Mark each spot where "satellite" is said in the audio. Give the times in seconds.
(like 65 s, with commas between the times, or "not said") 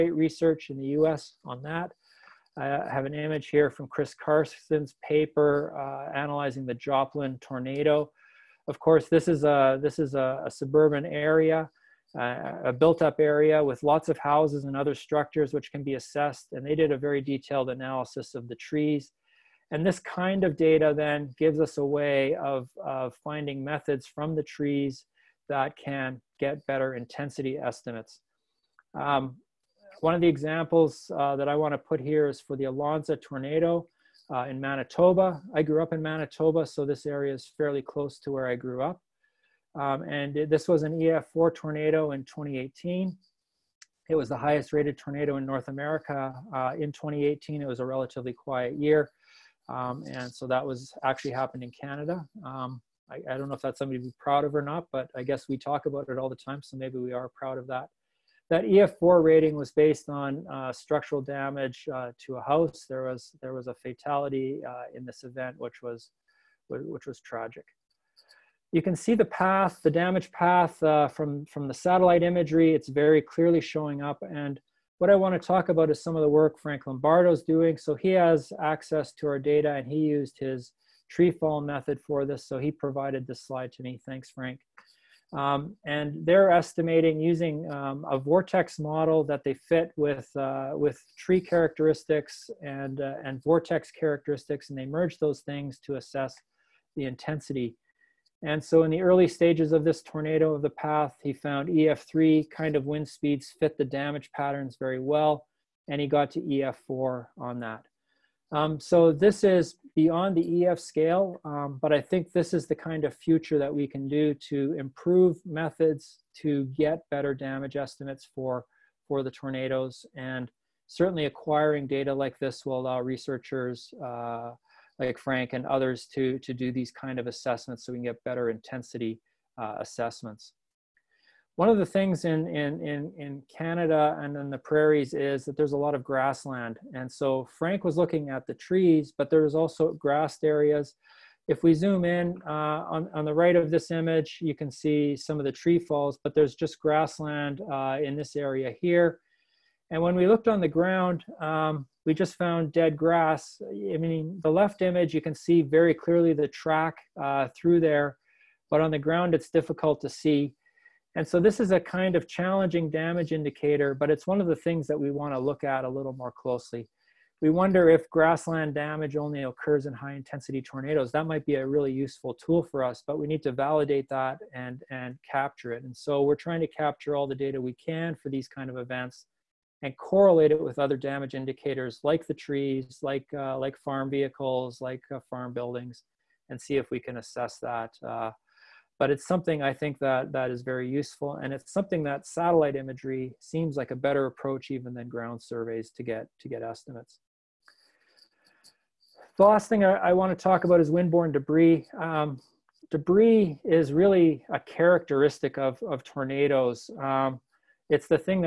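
71 s, 192 s.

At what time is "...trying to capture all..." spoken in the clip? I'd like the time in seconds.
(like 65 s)
176 s.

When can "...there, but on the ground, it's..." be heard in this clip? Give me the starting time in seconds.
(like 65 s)
157 s.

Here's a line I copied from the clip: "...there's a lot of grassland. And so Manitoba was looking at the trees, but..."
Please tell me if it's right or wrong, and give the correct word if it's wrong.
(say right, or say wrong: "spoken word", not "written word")
wrong: "Frank", not "Manitoba".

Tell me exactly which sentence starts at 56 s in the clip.
So maybe we are proud of that.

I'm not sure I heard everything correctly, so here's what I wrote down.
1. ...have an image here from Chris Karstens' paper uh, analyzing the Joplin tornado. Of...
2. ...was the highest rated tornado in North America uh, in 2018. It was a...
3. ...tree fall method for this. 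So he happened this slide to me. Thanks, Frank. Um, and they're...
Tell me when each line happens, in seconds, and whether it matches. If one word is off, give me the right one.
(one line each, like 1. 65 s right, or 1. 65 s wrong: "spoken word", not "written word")
1. 2 s right
2. 44 s right
3. 81 s wrong: "provided", not "happened".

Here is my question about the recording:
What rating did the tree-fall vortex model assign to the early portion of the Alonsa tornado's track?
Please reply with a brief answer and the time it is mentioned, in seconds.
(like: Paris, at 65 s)
EF3, at 101 s.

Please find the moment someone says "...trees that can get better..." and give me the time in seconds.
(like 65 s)
24 s.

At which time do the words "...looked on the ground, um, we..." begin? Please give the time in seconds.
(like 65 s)
150 s.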